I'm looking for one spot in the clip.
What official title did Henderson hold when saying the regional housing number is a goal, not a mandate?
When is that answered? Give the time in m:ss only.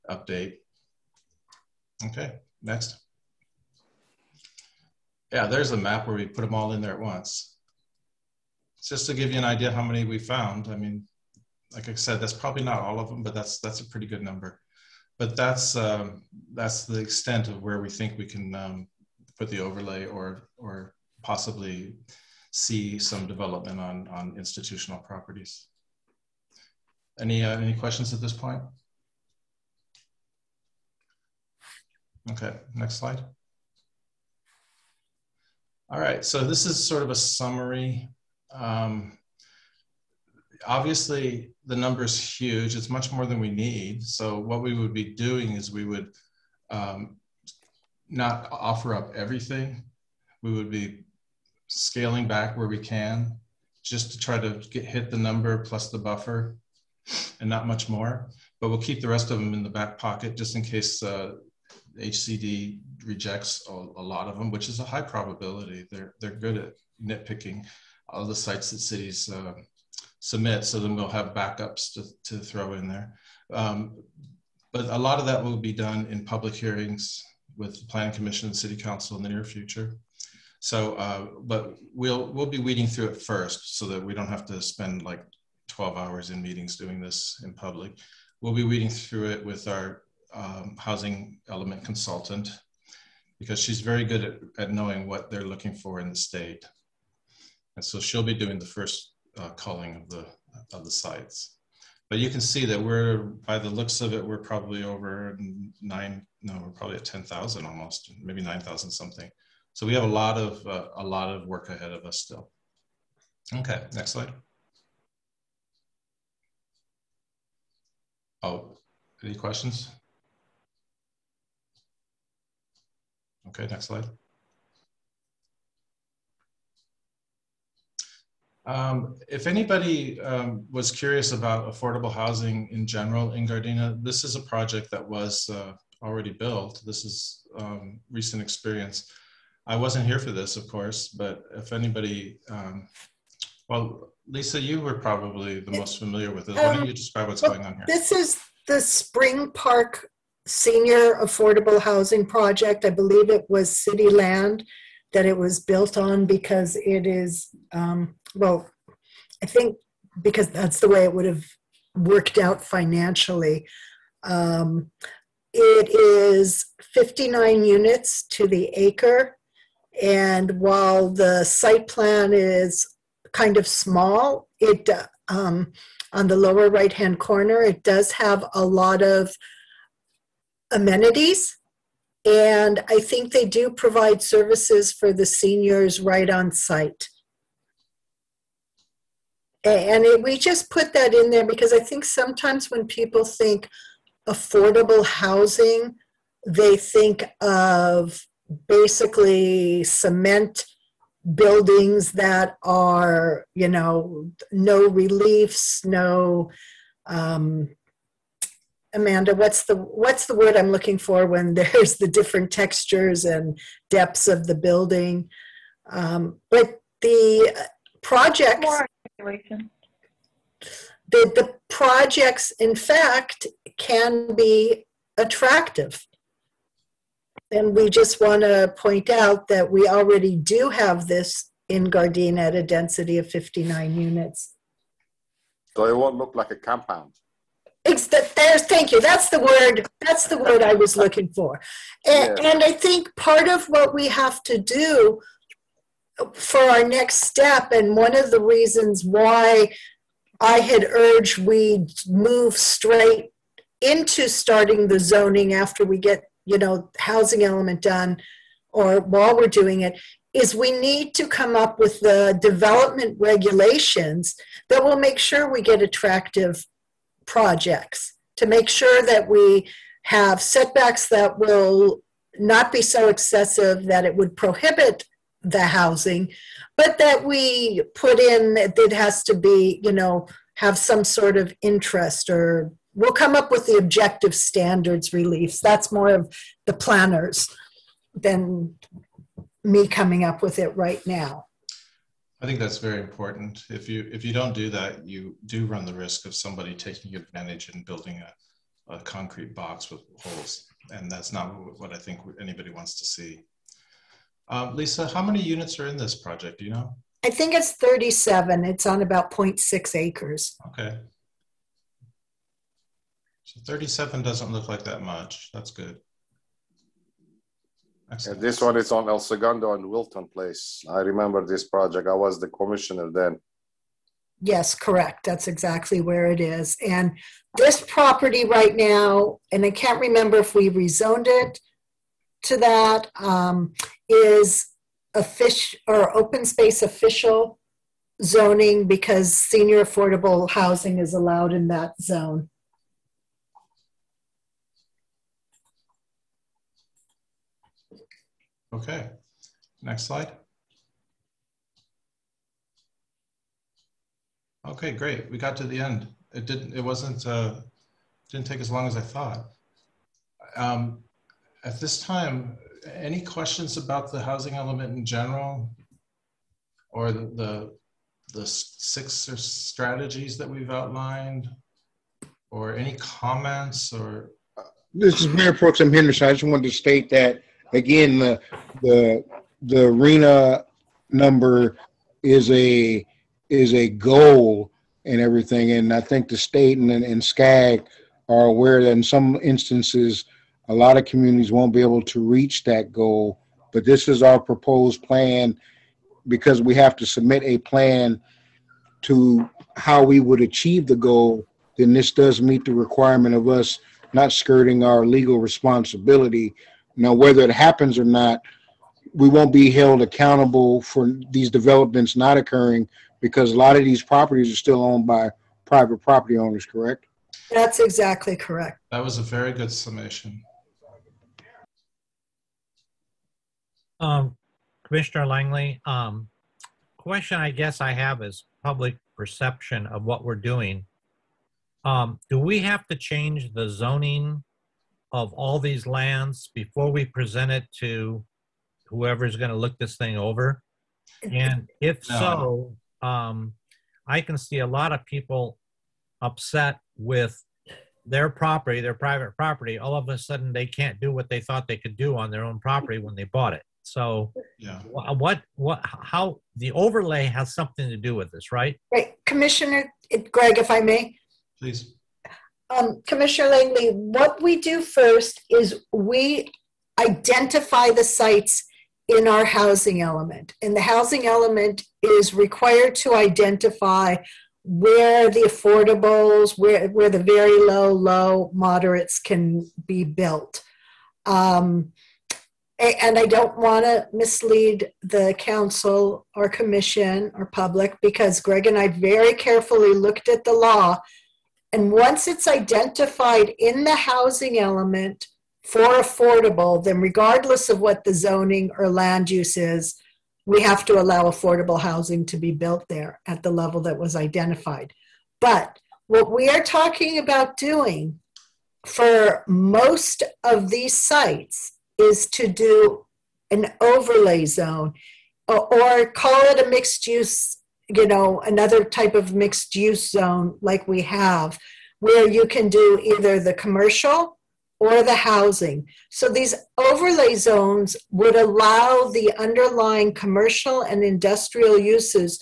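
6:15.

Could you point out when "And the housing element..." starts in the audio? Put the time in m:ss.
7:50.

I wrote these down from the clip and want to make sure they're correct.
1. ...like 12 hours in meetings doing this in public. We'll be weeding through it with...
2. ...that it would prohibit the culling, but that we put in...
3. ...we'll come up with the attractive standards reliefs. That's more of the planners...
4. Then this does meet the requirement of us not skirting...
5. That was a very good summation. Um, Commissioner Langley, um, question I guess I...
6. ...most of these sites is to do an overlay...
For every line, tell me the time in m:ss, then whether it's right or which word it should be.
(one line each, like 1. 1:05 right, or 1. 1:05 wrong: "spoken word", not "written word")
1. 1:25 right
2. 4:33 wrong: "housing", not "culling"
3. 4:42 wrong: "objective", not "attractive"
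4. 6:41 right
5. 6:58 right
6. 8:29 right.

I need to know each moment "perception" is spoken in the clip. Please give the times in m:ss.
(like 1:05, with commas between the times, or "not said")
7:09.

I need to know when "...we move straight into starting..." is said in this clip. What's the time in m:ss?
4:11.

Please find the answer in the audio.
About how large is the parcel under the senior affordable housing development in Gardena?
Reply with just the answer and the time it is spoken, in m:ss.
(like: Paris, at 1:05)
0.6 acres, at 5:09.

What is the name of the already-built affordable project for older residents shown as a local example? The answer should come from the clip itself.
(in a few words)
Spring Park Senior Affordable Housing Project.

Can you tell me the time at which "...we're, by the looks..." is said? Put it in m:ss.
1:42.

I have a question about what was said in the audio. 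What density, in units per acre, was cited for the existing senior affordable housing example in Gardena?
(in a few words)
59 units to the acre.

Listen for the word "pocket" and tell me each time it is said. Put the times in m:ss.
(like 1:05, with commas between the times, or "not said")
0:59.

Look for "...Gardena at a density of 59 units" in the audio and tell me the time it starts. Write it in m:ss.
3:51.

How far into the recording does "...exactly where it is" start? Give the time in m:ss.
5:25.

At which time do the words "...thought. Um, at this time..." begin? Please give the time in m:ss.
5:59.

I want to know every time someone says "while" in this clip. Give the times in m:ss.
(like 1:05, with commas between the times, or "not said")
2:50, 4:18.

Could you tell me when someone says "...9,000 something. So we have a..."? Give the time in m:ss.
1:48.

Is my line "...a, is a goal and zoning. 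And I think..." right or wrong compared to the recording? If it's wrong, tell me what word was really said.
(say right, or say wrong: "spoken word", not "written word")
wrong: "everything", not "zoning".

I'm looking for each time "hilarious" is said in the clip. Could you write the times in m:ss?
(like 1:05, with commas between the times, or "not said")
not said.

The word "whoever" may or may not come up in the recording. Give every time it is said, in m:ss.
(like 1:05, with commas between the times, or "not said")
7:18.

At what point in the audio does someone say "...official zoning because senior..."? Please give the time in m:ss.
5:36.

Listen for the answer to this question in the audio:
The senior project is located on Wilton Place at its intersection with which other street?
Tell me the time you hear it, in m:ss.
5:19.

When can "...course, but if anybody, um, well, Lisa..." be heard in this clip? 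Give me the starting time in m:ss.
2:20.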